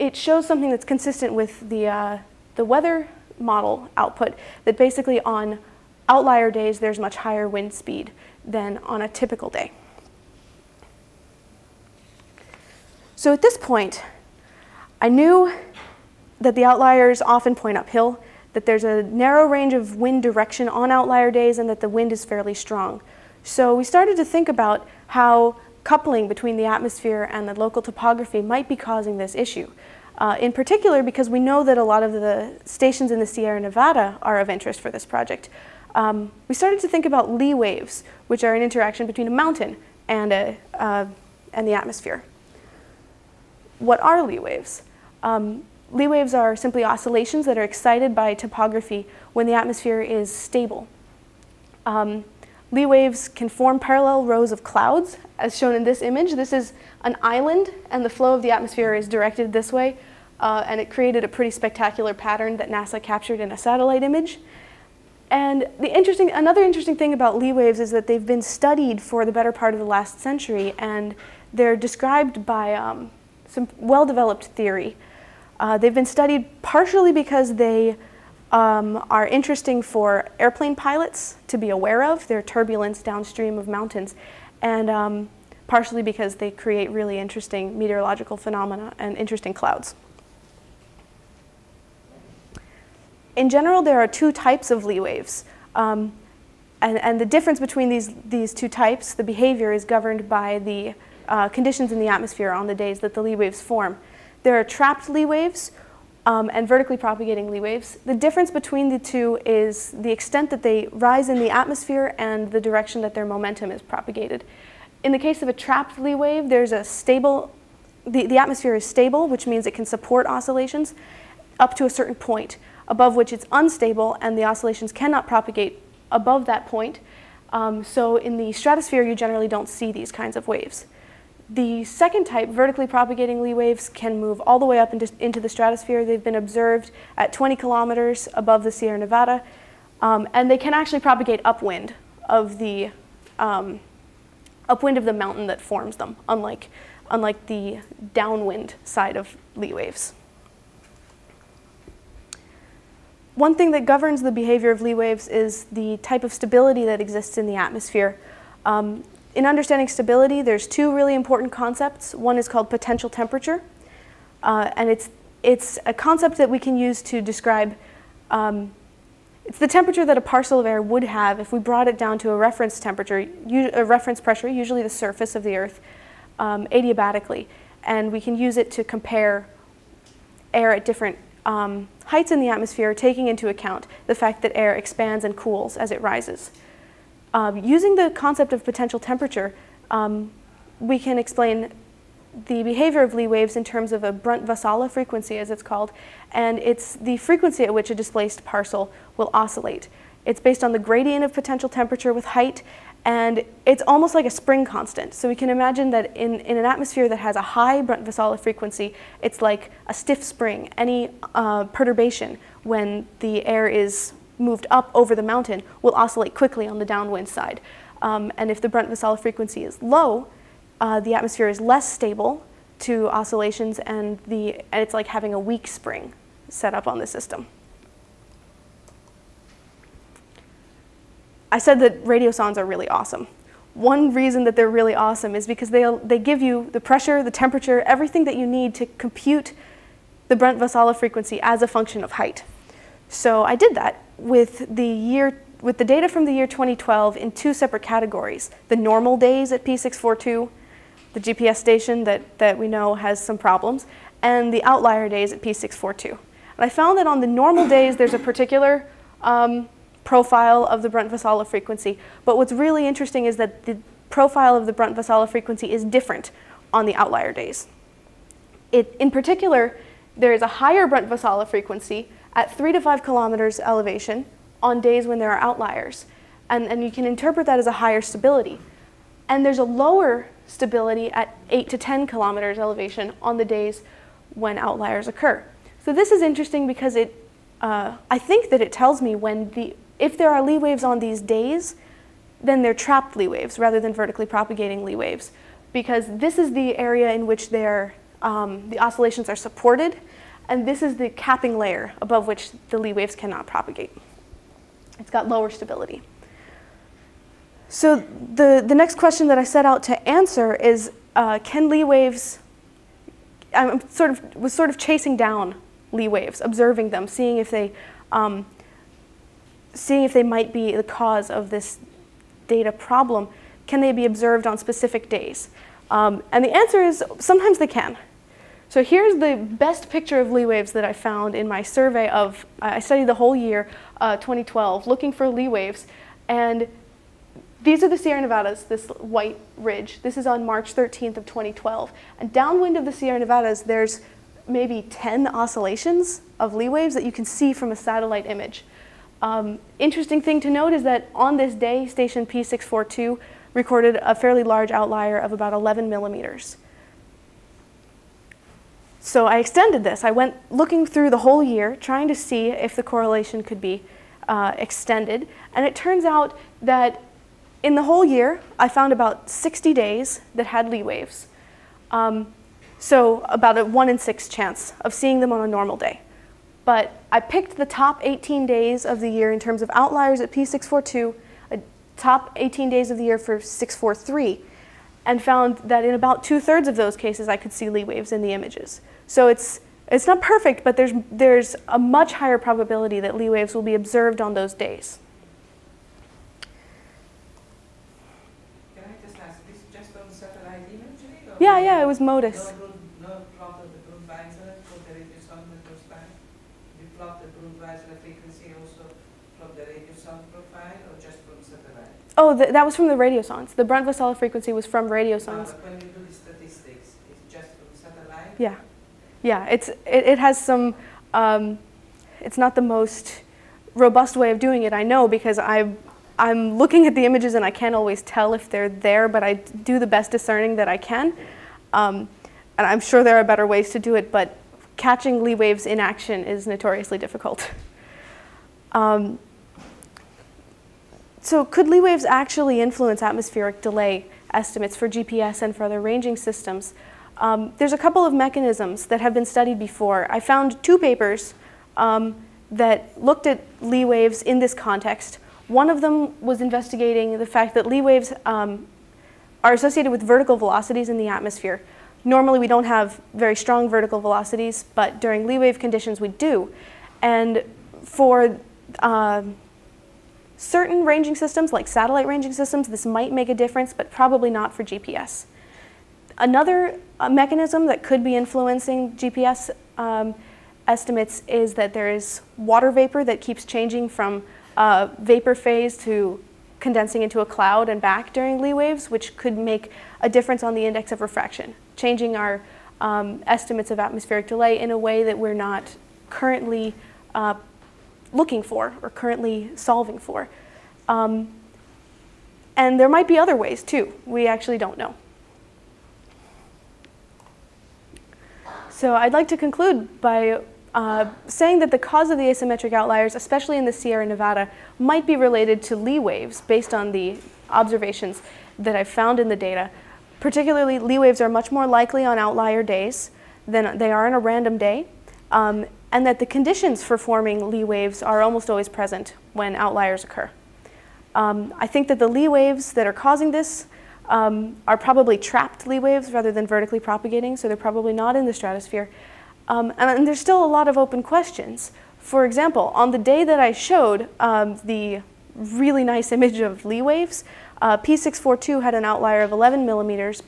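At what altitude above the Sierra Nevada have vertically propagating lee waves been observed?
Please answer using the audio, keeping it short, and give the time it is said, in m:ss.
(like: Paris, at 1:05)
20 kilometers, at 2:17.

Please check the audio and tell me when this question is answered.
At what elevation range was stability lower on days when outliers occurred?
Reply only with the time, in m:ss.
4:41.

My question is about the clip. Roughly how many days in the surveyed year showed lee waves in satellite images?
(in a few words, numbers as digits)
60.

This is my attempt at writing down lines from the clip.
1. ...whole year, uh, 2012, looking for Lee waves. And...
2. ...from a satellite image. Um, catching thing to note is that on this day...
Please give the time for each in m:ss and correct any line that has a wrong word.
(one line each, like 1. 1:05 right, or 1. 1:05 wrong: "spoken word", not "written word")
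1. 5:33 right
2. 5:47 wrong: "interesting", not "catching".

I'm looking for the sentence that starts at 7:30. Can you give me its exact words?
I found two papers um, that looked at lee waves in this context.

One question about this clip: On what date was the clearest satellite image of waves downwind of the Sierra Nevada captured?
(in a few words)
March 13.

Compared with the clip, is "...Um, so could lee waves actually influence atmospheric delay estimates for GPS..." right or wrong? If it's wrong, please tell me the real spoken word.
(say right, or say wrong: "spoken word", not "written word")
right.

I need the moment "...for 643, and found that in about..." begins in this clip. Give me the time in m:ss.
6:23.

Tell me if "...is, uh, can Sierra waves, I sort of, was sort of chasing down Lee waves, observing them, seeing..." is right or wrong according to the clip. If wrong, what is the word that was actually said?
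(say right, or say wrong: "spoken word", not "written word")
wrong: "Lee", not "Sierra".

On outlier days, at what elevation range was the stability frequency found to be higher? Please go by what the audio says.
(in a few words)
3 to 5 kilometers.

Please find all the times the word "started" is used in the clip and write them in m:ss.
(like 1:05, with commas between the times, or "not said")
0:23, 0:36.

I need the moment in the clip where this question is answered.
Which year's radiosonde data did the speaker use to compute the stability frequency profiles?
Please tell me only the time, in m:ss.
4:06.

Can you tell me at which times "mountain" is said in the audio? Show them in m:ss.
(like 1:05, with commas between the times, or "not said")
0:39, 1:23, 2:25, 3:35.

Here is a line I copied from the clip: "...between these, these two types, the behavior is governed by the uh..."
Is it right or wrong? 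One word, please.
right.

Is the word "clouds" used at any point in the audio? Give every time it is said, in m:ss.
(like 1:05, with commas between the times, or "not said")
0:54, 1:29, 8:07.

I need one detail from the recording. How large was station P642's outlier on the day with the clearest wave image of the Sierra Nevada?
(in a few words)
11 millimeters.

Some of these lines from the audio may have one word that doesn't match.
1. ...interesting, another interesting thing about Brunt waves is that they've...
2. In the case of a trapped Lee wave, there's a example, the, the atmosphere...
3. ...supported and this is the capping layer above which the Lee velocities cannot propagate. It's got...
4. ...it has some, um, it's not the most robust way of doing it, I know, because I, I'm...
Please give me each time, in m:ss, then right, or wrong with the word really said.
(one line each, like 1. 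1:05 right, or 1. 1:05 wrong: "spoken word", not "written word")
1. 1:05 wrong: "Lee", not "Brunt"
2. 1:55 wrong: "stable", not "example"
3. 4:59 wrong: "waves", not "velocities"
4. 7:00 right.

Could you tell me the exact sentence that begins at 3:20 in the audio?
It's based on the gradient of potential temperature with height, and it's almost like a spring constant.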